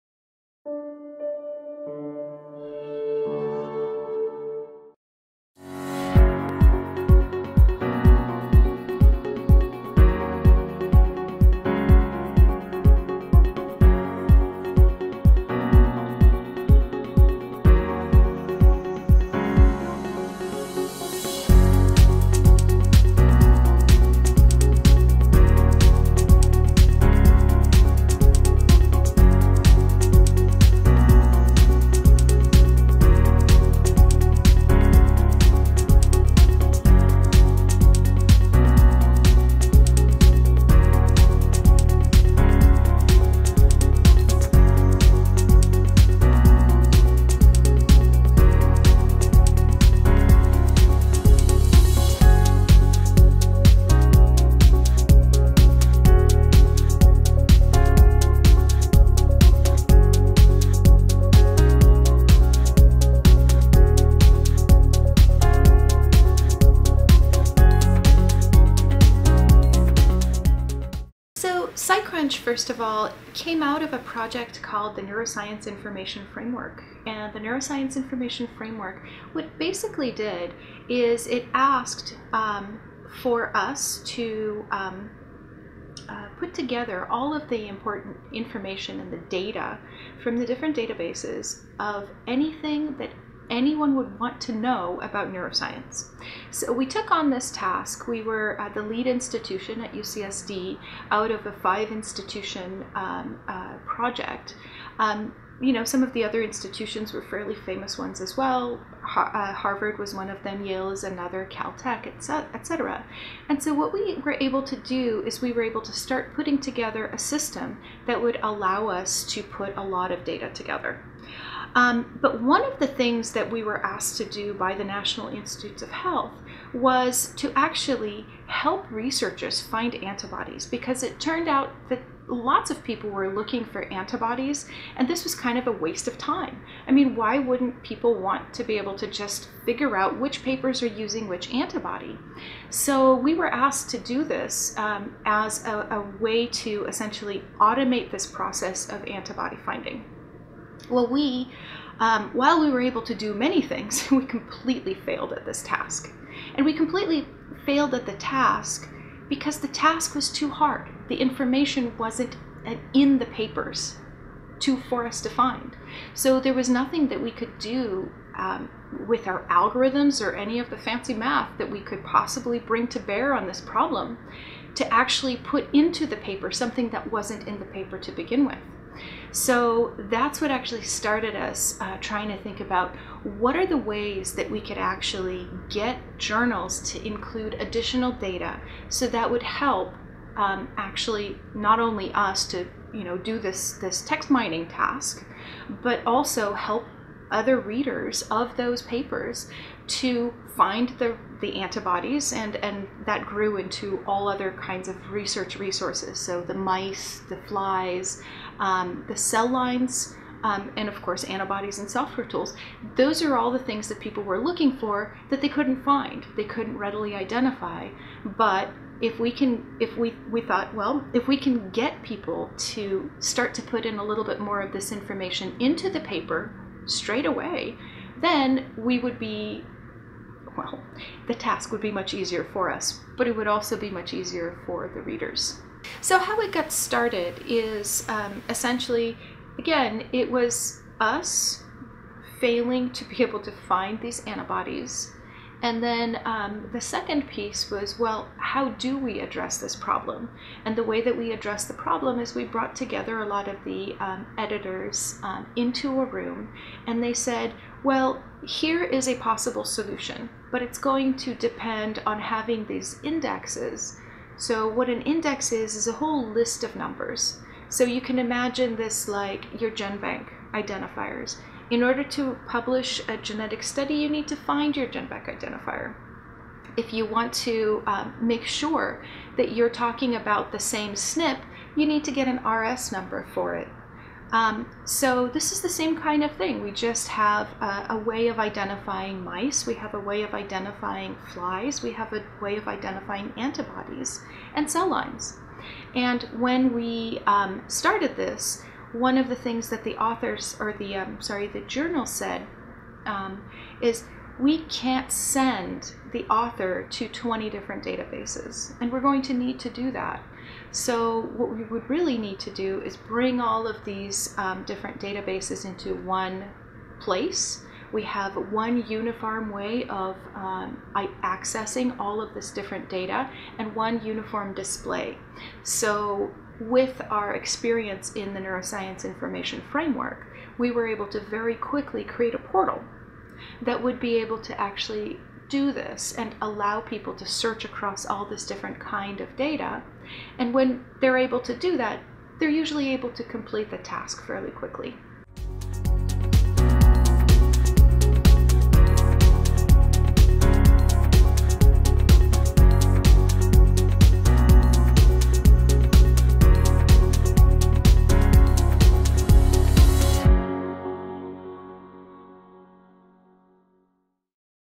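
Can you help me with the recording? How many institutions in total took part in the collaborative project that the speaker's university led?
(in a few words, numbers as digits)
5.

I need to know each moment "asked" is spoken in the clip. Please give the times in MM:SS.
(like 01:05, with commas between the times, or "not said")
01:21, 02:03, 02:23.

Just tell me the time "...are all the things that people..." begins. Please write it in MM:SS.
03:33.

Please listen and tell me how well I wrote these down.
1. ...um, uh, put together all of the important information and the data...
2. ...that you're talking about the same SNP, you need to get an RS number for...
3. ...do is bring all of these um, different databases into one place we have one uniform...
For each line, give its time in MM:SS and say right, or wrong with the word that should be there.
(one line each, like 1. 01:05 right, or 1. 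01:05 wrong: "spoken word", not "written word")
1. 01:24 right
2. 04:39 right
3. 05:12 right.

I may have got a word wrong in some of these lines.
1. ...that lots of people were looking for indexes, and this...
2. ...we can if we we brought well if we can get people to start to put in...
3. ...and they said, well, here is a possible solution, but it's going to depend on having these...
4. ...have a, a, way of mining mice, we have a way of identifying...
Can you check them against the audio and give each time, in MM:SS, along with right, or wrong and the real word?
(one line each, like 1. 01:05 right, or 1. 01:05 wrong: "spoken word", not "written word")
1. 02:11 wrong: "antibodies", not "indexes"
2. 03:39 wrong: "thought", not "brought"
3. 04:16 right
4. 04:47 wrong: "identifying", not "mining".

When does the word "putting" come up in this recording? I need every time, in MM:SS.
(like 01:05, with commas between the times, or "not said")
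01:56.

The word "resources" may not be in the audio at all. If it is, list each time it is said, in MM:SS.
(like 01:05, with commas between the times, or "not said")
03:25.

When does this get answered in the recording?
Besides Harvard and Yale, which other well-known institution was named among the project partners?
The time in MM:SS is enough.
01:51.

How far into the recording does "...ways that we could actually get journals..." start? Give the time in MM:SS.
03:03.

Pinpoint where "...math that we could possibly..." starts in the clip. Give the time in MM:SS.
02:51.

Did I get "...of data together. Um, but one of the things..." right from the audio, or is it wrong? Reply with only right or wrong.
right.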